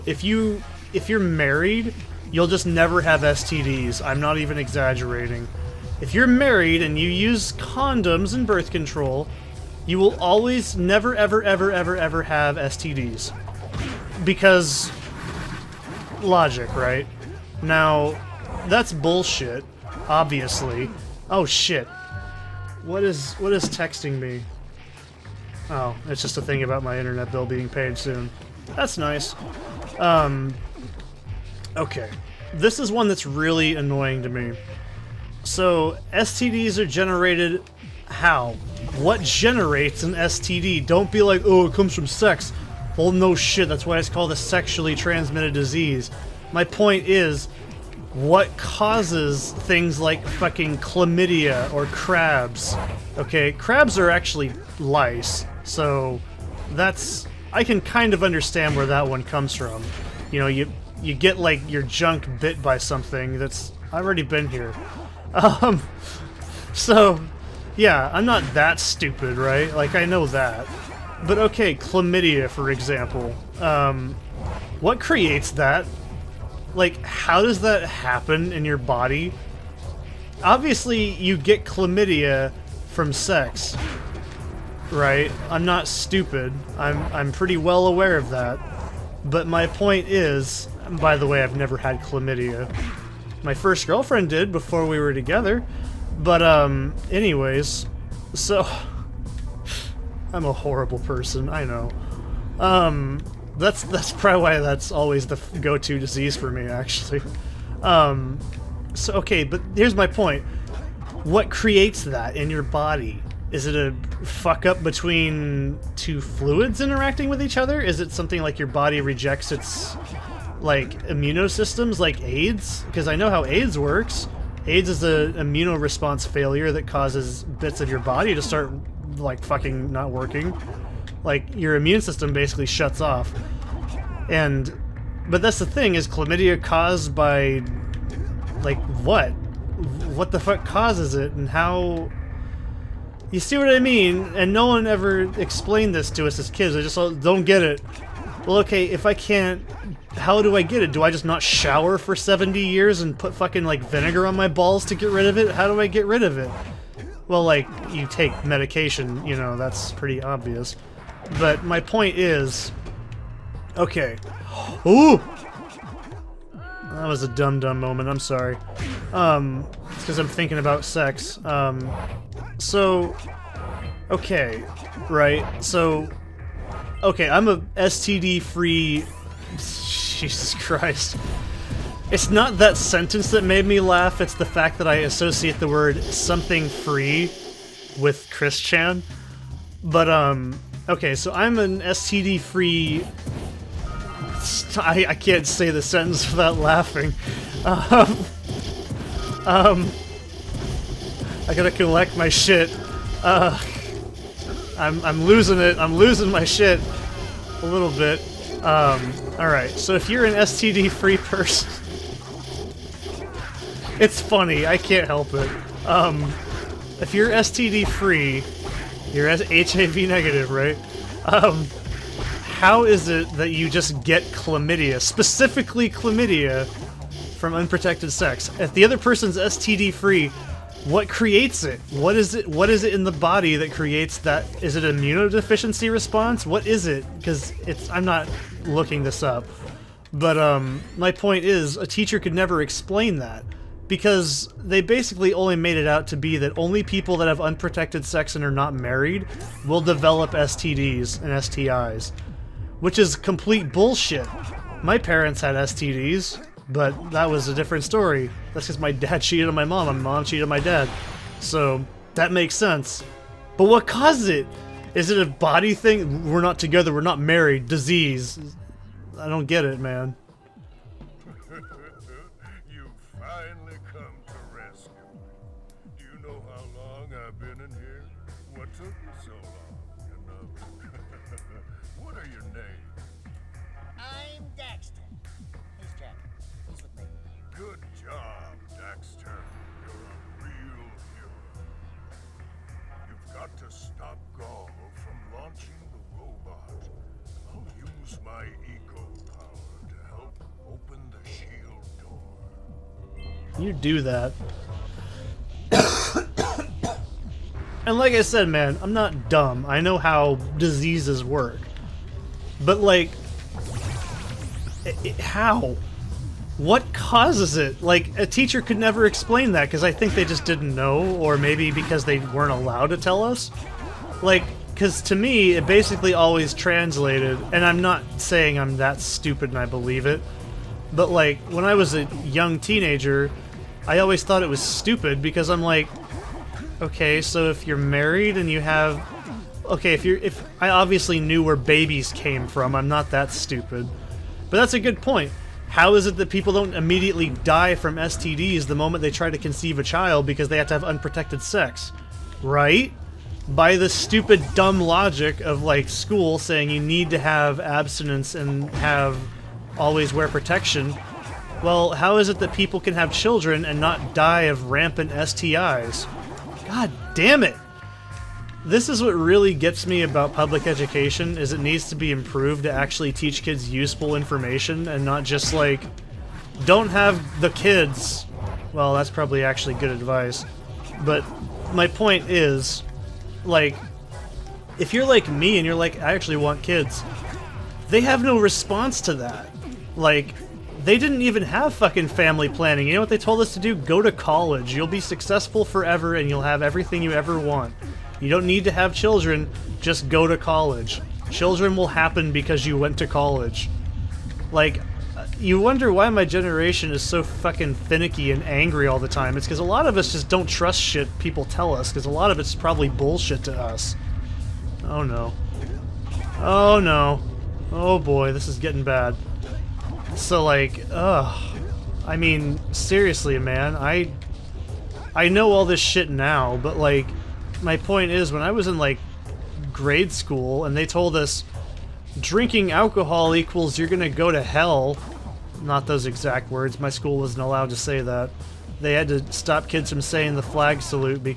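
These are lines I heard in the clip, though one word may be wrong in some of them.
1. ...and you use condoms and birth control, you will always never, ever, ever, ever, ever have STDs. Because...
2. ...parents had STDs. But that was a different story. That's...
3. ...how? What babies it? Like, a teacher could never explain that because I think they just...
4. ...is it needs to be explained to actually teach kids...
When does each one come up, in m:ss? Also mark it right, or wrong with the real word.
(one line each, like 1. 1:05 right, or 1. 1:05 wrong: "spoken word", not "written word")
1. 0:06 right
2. 4:14 right
3. 5:15 wrong: "causes", not "babies"
4. 6:11 wrong: "improved", not "explained".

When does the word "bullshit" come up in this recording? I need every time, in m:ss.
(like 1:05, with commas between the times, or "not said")
0:18, 4:13, 6:52.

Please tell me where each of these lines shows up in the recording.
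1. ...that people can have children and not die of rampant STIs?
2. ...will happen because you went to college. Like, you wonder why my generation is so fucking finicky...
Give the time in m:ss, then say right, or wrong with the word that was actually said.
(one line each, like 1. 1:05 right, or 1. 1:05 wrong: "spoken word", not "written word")
1. 6:02 right
2. 6:41 right.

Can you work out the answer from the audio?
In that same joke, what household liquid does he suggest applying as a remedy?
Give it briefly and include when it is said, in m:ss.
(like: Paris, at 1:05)
vinegar, at 2:33.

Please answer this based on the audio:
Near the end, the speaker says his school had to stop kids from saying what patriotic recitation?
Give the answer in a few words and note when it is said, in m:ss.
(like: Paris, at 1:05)
flag salute, at 7:20.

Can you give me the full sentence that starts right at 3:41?
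Um, how is it that you just get chlamydia, specifically chlamydia, from unprotected sex?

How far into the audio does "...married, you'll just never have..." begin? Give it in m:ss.
0:01.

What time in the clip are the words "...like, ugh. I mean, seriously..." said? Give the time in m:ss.
7:00.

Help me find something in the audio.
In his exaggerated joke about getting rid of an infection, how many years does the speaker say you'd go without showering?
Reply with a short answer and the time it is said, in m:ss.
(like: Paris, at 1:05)
70, at 2:32.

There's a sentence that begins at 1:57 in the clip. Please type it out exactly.
Is it something like your body rejects its like immunosystems like AIDS?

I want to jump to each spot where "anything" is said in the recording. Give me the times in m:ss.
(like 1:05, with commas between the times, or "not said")
not said.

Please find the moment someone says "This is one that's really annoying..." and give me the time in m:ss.
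0:32.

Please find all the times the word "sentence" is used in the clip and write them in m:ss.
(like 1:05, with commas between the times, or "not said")
3:02, 3:15.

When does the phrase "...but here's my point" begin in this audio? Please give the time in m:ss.
1:49.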